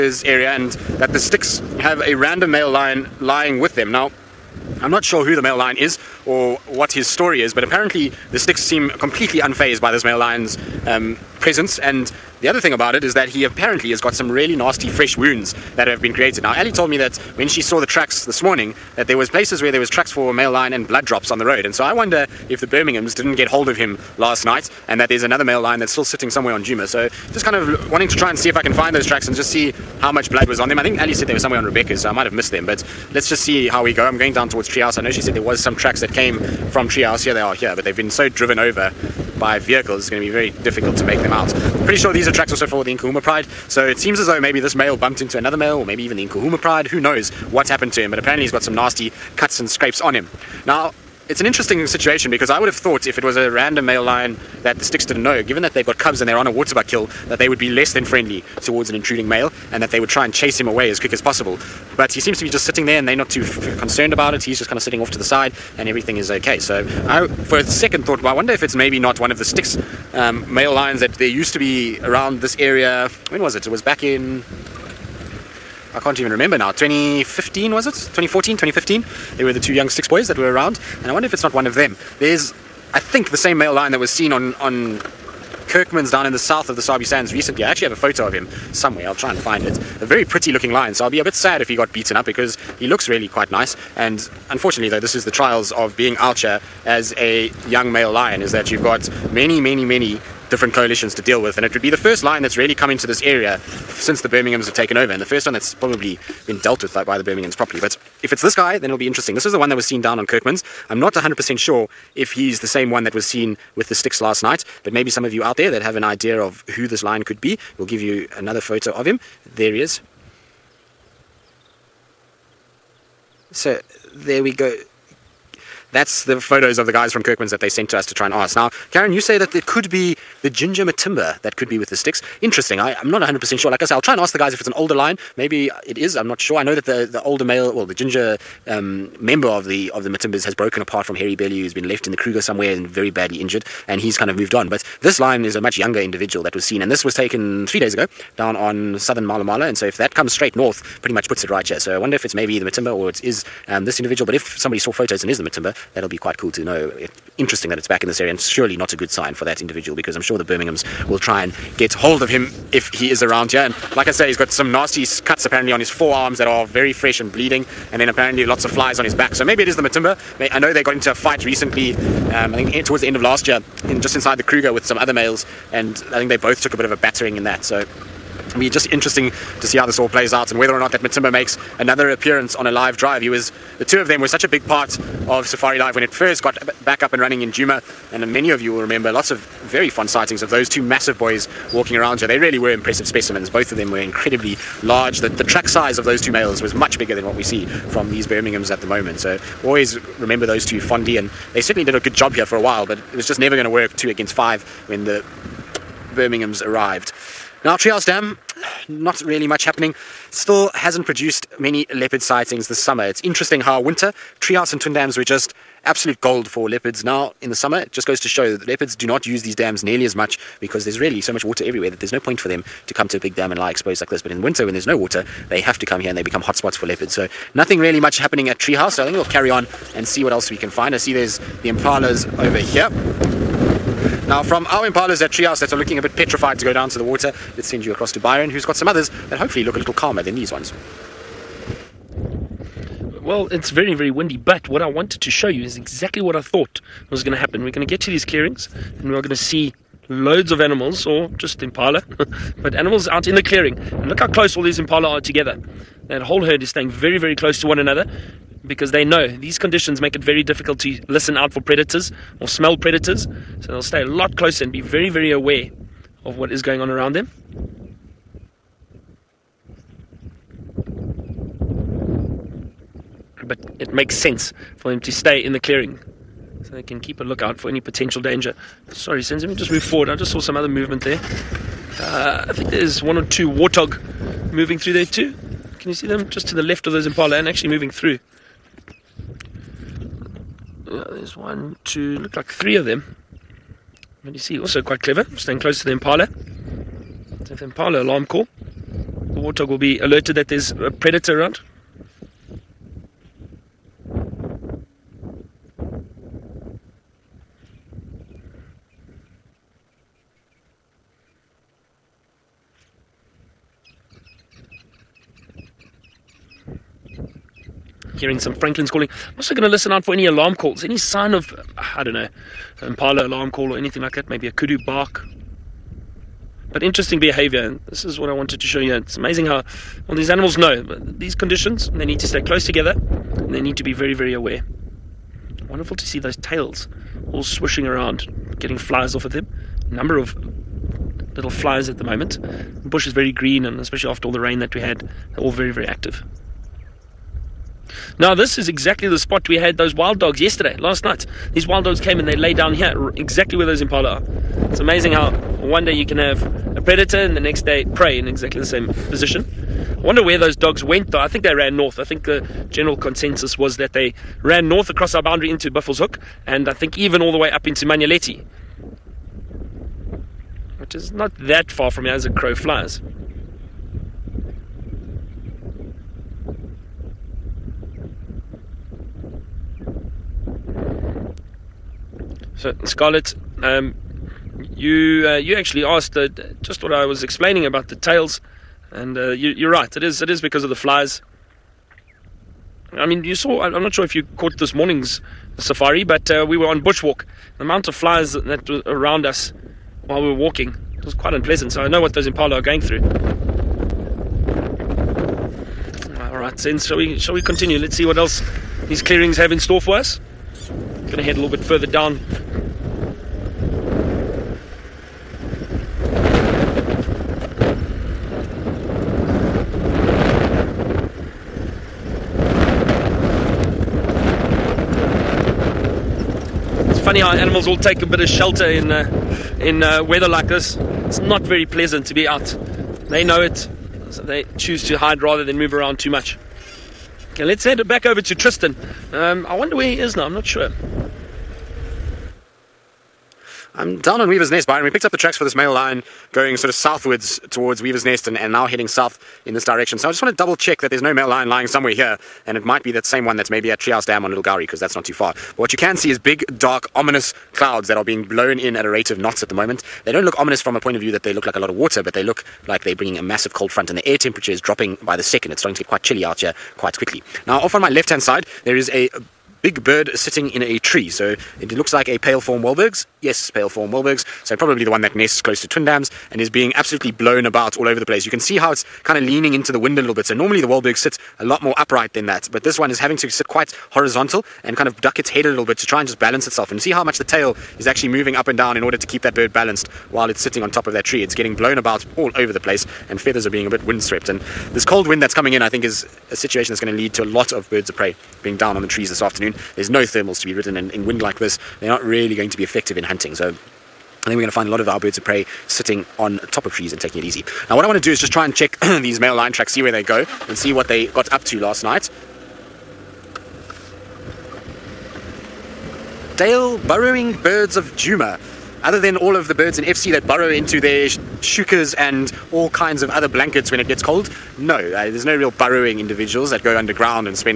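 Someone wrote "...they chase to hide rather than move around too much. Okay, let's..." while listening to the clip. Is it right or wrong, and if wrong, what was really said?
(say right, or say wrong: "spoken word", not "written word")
wrong: "choose", not "chase".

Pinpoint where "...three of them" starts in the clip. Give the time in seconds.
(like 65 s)
292 s.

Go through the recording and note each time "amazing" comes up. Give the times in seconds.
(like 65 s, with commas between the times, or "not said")
329 s, 354 s.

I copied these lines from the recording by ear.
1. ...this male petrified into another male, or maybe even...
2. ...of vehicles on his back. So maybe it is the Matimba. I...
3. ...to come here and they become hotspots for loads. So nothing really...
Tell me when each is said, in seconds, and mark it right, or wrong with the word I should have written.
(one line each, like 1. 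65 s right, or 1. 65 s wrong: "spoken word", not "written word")
1. 44 s wrong: "bumped", not "petrified"
2. 168 s wrong: "flies", not "vehicles"
3. 225 s wrong: "leopards", not "loads".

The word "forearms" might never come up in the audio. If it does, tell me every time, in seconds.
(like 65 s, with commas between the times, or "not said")
165 s.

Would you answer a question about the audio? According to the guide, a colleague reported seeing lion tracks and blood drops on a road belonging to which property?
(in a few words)
Rebecca's.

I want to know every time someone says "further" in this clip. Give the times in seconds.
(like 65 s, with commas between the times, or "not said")
411 s.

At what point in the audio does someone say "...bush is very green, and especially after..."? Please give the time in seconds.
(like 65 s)
342 s.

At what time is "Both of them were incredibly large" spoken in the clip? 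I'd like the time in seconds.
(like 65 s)
193 s.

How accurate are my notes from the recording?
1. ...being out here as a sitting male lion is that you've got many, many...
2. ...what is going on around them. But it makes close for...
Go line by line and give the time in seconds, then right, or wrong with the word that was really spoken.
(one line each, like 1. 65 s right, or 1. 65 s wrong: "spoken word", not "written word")
1. 95 s wrong: "young", not "sitting"
2. 266 s wrong: "sense", not "close".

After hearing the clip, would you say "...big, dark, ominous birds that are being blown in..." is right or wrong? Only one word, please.
wrong.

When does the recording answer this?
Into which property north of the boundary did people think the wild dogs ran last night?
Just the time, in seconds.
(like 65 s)
365 s.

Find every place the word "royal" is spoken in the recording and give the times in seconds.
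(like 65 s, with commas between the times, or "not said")
not said.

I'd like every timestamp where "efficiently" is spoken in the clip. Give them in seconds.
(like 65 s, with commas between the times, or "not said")
not said.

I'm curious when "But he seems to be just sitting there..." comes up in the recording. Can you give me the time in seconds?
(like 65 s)
61 s.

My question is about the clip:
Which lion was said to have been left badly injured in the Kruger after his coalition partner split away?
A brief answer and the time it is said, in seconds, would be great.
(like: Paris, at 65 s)
Hairy Belly, at 141 s.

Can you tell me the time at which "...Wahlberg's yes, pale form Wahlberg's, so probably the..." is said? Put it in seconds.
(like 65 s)
472 s.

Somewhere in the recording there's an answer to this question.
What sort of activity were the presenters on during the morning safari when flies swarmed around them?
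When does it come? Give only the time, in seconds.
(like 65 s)
396 s.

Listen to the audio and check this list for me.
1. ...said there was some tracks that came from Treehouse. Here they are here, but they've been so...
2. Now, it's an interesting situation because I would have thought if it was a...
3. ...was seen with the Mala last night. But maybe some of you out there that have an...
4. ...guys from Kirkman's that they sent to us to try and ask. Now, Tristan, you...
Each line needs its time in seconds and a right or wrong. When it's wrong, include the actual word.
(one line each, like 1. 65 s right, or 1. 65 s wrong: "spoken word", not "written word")
1. 35 s right
2. 50 s right
3. 113 s wrong: "Styx", not "Mala"
4. 126 s wrong: "Karen", not "Tristan".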